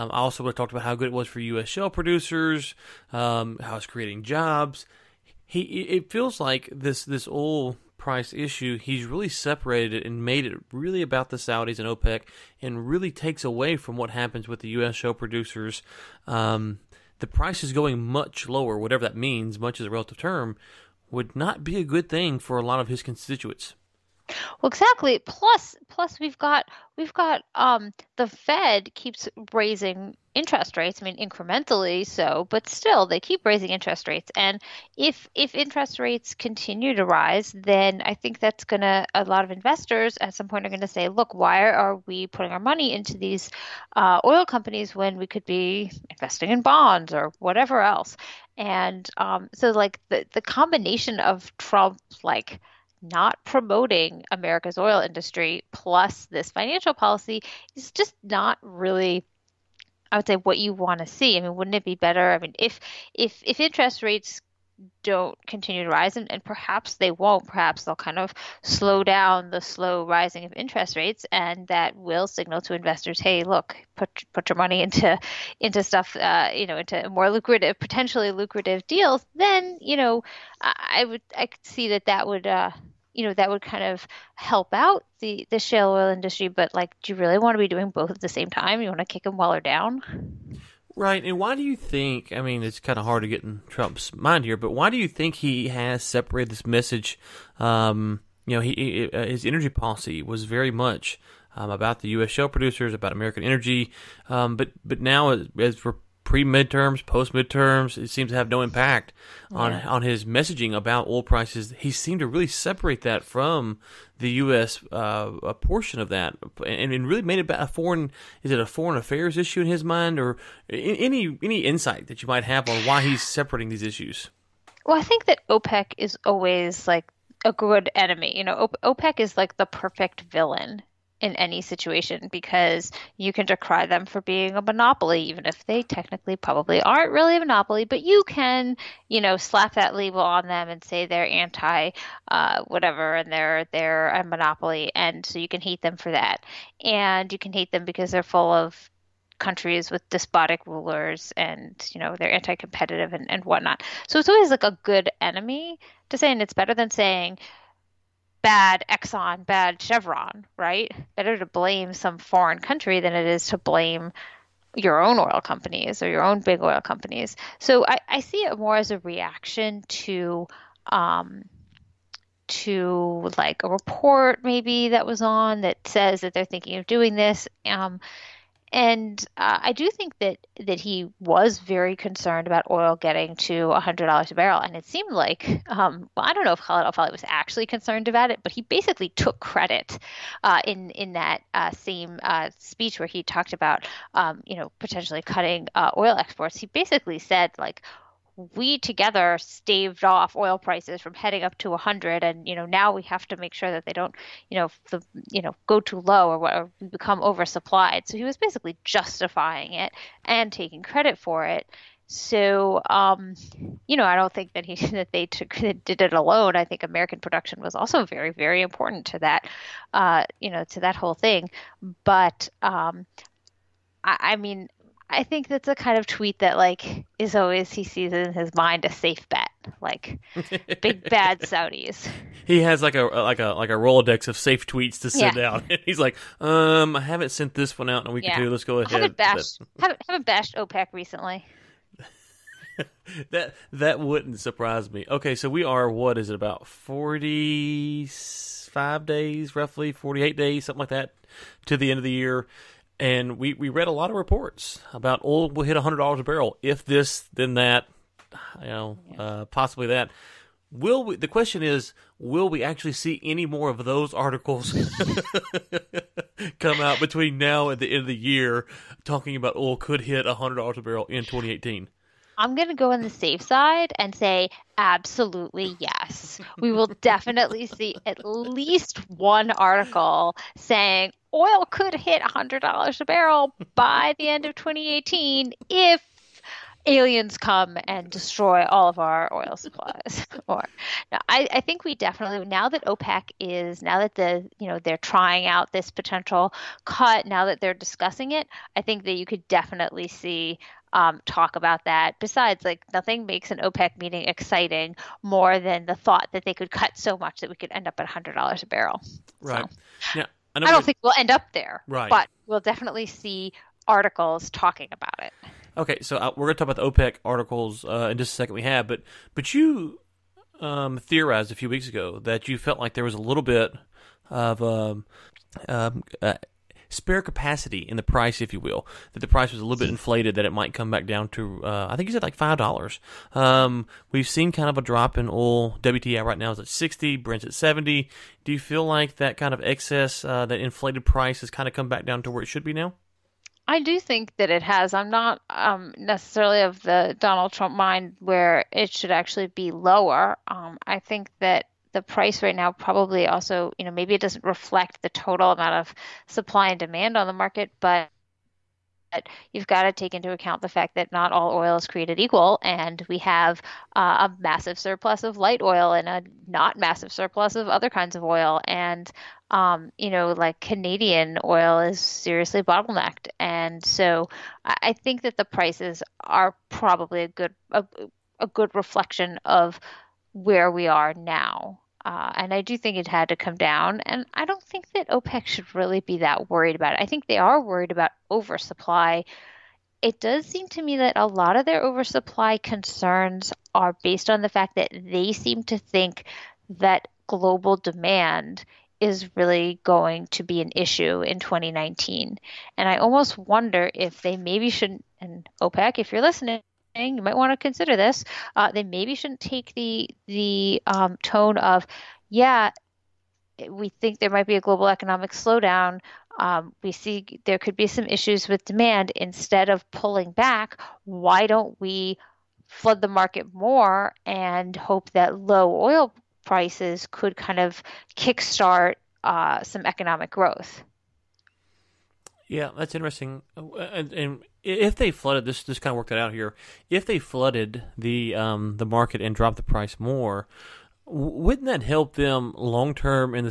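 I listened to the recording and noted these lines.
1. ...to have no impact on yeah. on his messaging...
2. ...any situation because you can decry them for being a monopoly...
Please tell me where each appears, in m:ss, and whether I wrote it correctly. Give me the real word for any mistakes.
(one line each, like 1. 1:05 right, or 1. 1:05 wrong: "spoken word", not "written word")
1. 1:48 right
2. 2:11 right.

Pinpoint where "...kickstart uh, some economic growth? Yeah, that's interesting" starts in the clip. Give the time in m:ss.
7:08.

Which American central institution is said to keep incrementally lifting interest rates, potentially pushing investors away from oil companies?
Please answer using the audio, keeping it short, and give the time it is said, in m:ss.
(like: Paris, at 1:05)
The Fed, at 0:28.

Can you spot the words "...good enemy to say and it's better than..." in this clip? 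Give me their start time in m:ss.
2:34.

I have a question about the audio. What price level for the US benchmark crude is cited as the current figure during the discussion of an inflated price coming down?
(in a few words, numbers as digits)
$60.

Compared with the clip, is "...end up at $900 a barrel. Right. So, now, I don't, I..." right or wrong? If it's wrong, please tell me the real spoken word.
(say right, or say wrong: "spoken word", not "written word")
wrong: "100", not "900".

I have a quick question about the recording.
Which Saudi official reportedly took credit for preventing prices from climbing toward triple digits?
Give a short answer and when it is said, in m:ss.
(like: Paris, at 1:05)
Khalid al-Falih, at 3:06.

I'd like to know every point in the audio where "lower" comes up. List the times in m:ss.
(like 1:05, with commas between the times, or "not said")
0:18, 5:49.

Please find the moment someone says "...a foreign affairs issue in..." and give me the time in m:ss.
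1:58.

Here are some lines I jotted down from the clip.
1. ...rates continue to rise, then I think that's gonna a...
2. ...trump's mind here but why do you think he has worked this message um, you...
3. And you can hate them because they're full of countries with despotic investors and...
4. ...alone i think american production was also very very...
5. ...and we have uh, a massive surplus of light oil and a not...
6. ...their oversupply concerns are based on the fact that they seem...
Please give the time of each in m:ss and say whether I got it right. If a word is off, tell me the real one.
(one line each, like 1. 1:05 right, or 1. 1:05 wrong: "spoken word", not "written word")
1. 0:35 right
2. 1:33 wrong: "separated", not "worked"
3. 2:26 wrong: "rulers", not "investors"
4. 3:36 right
5. 6:02 right
6. 6:31 right.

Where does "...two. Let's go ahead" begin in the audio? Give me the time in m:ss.
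3:58.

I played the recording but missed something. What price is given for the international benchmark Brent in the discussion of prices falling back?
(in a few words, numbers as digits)
$70.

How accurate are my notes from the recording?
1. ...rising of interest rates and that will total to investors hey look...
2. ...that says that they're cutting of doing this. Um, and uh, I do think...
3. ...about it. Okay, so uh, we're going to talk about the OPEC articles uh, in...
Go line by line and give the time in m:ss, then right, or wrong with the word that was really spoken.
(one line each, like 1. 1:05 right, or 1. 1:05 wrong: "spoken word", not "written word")
1. 1:10 wrong: "signal", not "total"
2. 2:55 wrong: "thinking", not "cutting"
3. 5:14 right.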